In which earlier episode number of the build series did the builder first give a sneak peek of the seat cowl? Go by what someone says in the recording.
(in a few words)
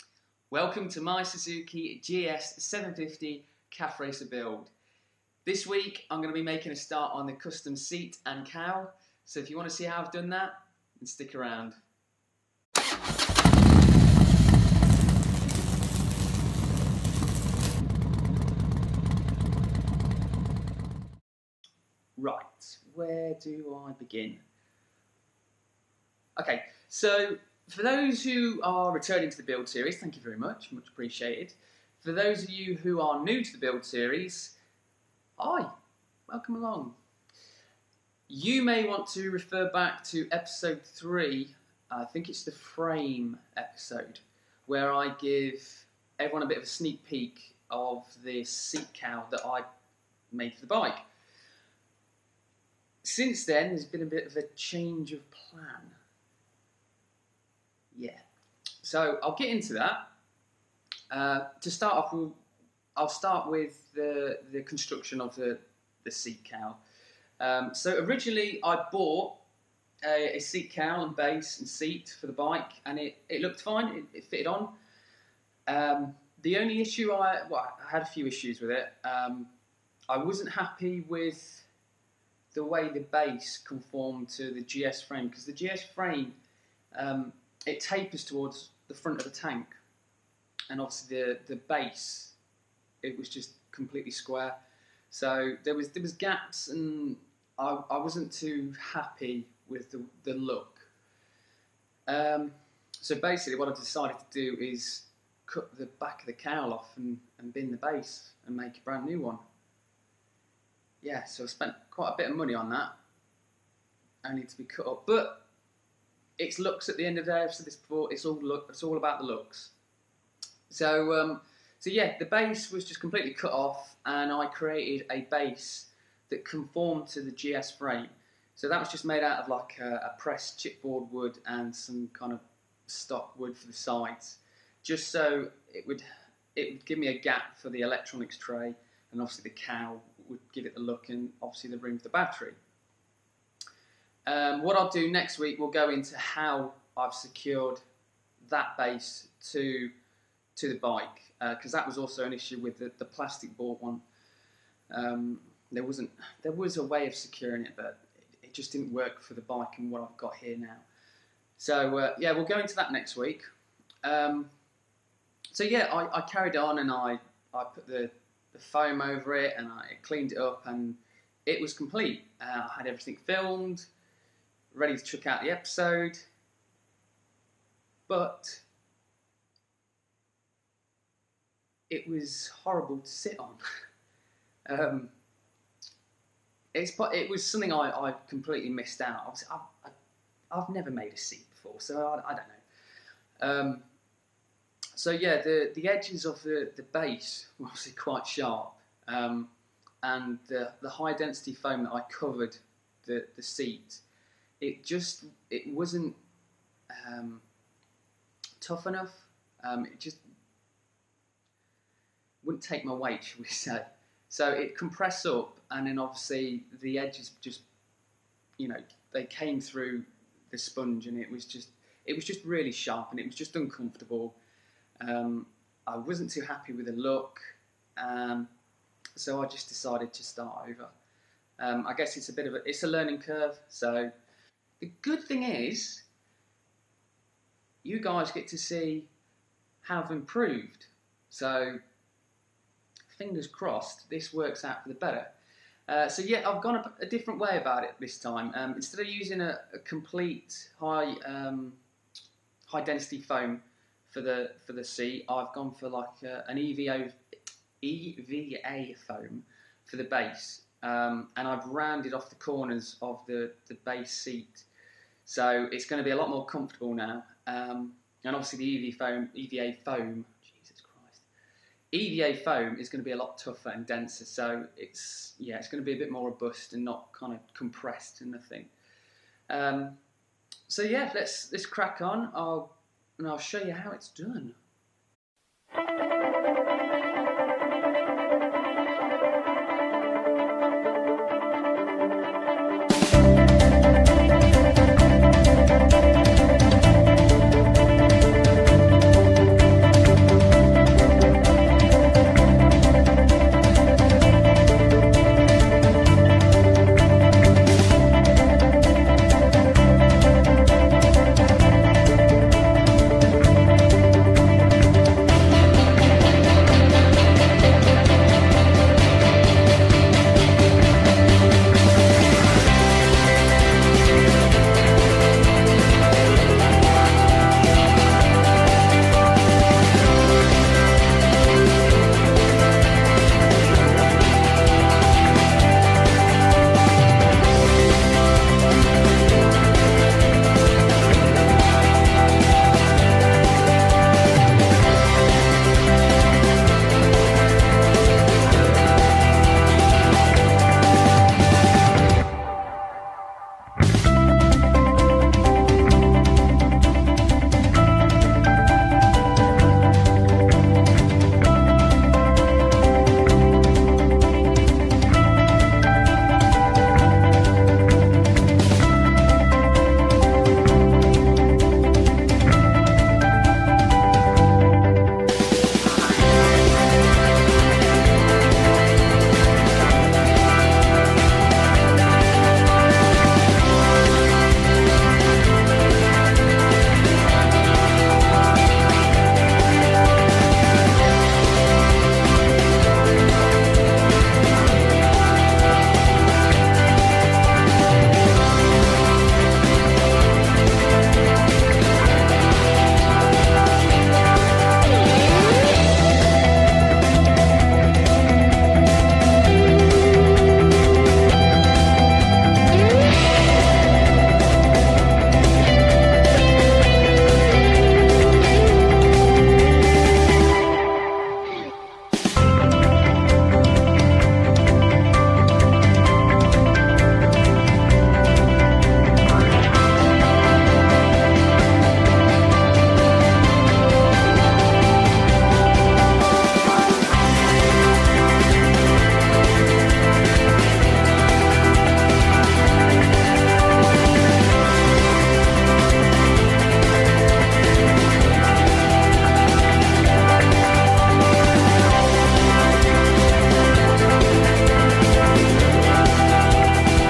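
3.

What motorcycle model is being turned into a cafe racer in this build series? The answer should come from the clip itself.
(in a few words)
Suzuki GS750.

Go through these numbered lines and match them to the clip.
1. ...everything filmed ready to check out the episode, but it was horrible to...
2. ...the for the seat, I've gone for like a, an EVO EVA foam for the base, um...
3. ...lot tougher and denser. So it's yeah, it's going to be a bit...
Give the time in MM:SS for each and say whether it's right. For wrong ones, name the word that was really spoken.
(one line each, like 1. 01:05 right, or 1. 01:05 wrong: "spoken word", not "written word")
1. 02:52 right
2. 04:14 right
3. 04:33 right.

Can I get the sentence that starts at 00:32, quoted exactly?
For those of you who are new to the build series, hi, welcome along.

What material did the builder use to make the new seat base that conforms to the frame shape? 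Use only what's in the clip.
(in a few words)
Pressed chipboard wood.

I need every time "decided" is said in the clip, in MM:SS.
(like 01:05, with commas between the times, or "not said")
01:43, 03:49.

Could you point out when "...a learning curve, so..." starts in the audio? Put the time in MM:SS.
03:52.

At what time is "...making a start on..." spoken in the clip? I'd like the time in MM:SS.
00:06.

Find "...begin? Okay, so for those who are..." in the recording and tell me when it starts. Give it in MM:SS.
00:23.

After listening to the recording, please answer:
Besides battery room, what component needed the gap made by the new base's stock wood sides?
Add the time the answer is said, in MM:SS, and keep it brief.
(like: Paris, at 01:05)
Electronics tray, at 02:17.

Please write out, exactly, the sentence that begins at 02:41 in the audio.
So uh, yeah, we'll go into that next week.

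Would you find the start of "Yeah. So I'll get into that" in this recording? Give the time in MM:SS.
00:58.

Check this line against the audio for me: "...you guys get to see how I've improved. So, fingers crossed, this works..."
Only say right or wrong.
right.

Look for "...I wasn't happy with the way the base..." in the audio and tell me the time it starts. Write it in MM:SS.
01:20.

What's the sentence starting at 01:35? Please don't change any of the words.
So there was there was gaps, and I, I wasn't too happy with the, the look.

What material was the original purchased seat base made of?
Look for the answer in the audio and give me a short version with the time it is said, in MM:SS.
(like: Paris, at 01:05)
Plastic board, at 02:33.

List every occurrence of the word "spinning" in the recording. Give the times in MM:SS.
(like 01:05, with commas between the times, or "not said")
not said.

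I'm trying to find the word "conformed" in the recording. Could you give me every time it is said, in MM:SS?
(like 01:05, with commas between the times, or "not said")
01:23, 02:06.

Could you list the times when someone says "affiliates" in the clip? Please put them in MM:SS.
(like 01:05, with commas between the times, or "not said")
not said.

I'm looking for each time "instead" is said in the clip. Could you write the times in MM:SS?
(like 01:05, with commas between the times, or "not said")
04:08.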